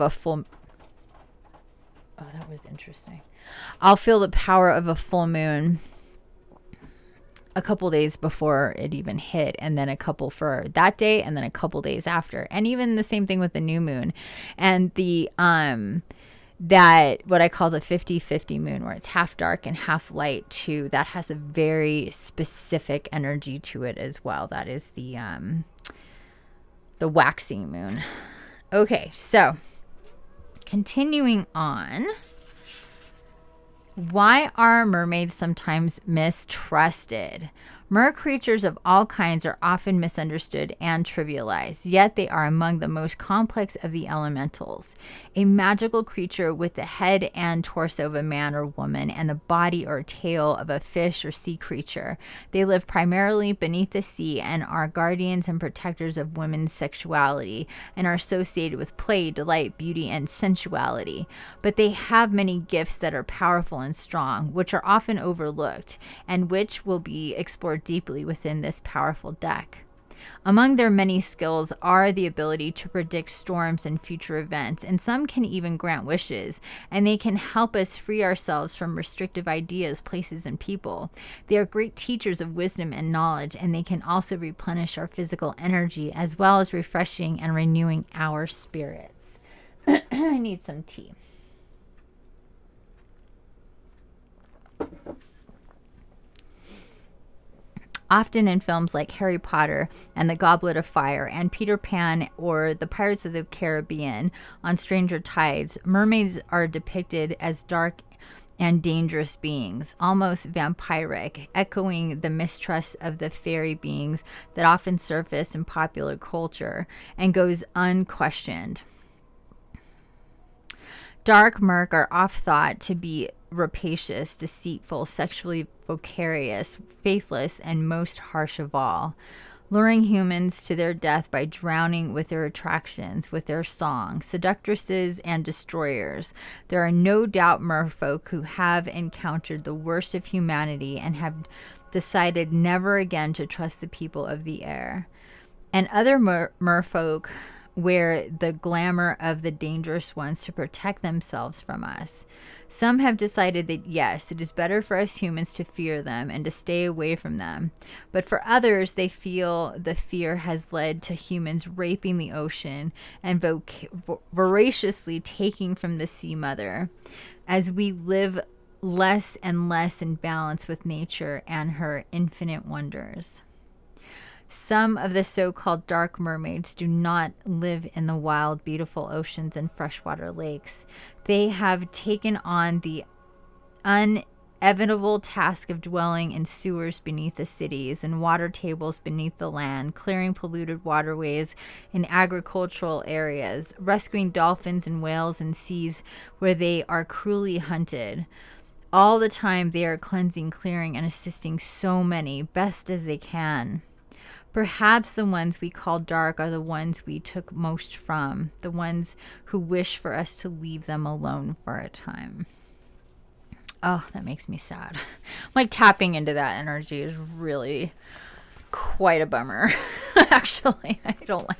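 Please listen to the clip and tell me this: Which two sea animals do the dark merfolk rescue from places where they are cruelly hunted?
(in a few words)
Dolphins and whales.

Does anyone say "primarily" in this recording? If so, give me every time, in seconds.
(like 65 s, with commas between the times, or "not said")
52 s.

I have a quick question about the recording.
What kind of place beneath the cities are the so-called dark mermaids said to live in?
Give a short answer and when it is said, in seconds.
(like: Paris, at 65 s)
Sewers, at 186 s.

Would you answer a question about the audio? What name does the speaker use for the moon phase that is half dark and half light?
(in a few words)
50 50 moon.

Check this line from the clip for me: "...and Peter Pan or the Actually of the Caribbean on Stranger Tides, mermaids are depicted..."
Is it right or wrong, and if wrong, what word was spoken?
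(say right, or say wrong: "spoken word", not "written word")
wrong: "Pirates", not "Actually".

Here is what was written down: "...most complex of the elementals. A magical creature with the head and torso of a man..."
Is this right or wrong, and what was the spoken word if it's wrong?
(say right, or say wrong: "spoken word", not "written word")
right.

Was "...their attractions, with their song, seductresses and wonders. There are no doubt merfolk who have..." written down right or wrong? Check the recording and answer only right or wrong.
wrong.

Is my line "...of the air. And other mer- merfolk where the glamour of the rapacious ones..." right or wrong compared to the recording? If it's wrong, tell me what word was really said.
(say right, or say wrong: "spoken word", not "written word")
wrong: "dangerous", not "rapacious".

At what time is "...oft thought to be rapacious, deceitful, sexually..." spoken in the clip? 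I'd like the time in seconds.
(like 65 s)
122 s.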